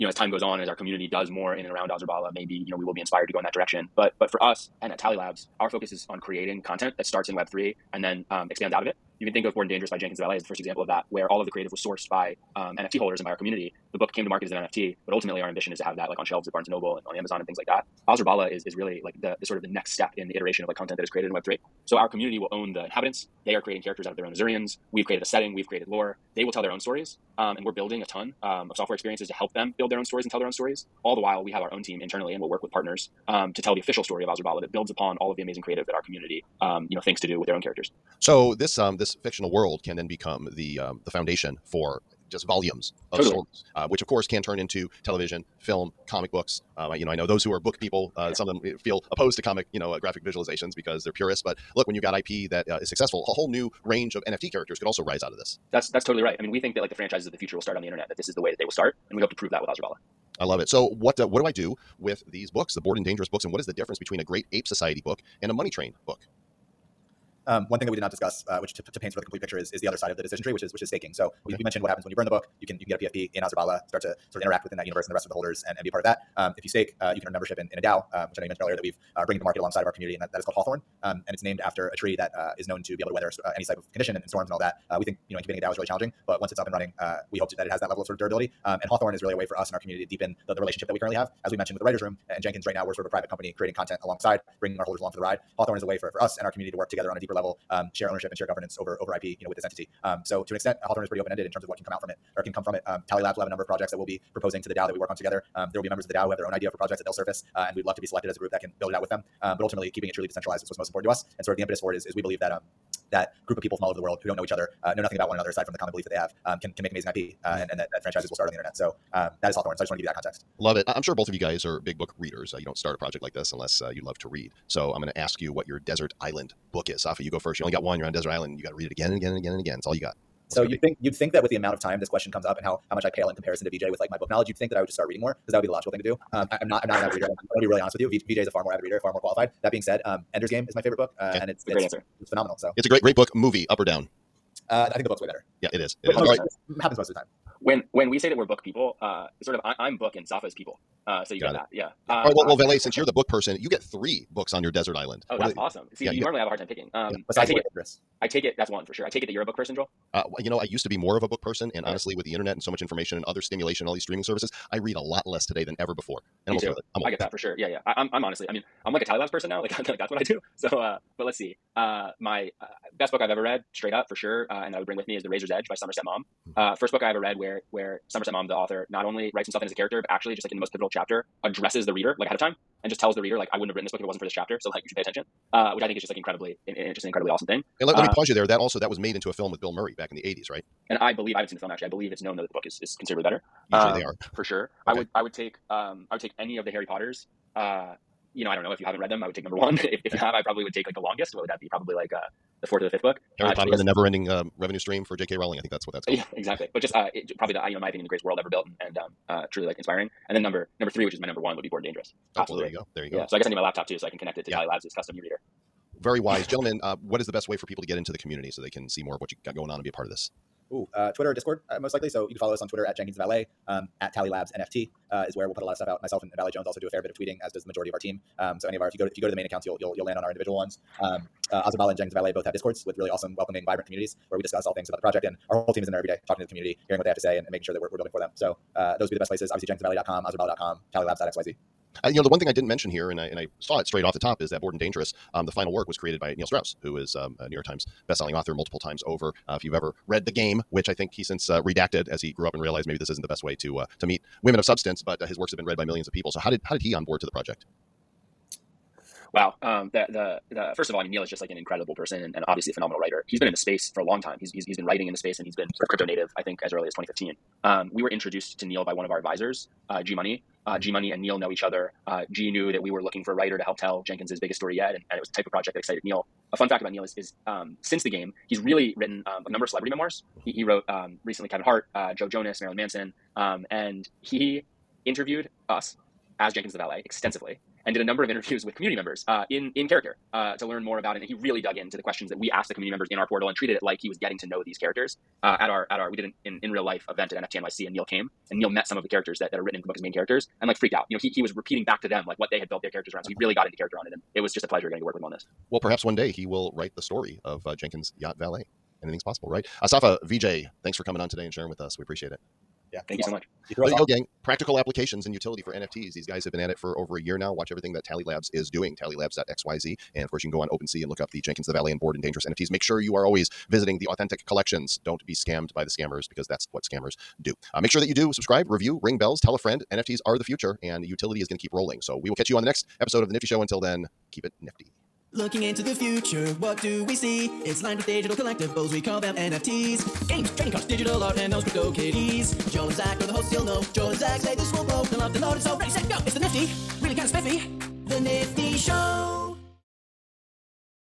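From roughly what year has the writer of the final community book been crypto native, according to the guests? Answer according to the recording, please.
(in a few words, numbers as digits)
2015.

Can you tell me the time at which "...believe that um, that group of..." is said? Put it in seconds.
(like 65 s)
112 s.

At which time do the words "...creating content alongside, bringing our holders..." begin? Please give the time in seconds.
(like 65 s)
93 s.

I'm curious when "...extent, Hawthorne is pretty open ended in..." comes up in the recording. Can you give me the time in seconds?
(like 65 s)
100 s.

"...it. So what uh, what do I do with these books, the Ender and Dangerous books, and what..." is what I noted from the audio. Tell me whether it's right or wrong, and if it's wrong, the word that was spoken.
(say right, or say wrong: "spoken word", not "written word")
wrong: "Bored", not "Ender".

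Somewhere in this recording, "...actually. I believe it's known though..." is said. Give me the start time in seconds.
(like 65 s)
191 s.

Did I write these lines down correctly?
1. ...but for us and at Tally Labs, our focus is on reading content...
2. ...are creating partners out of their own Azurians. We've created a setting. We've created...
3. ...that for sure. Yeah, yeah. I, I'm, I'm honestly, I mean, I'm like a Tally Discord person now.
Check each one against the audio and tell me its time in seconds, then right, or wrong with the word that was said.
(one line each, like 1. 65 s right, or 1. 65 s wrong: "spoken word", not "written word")
1. 4 s wrong: "creating", not "reading"
2. 23 s wrong: "characters", not "partners"
3. 167 s wrong: "Labs", not "Discord".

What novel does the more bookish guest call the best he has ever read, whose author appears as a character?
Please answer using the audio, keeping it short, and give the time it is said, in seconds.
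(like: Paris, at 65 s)
The Razor's Edge, at 175 s.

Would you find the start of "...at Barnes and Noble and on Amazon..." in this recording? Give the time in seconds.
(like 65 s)
16 s.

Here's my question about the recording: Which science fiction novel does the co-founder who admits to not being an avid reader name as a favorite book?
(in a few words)
Ender's Game.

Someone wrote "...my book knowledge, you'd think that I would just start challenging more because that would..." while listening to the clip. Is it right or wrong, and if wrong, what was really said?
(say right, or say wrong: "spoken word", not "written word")
wrong: "reading", not "challenging".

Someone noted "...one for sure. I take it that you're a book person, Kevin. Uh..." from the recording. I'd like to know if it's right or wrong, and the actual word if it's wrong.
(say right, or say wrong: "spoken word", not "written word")
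wrong: "Joel", not "Kevin".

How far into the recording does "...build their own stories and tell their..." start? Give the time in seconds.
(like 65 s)
29 s.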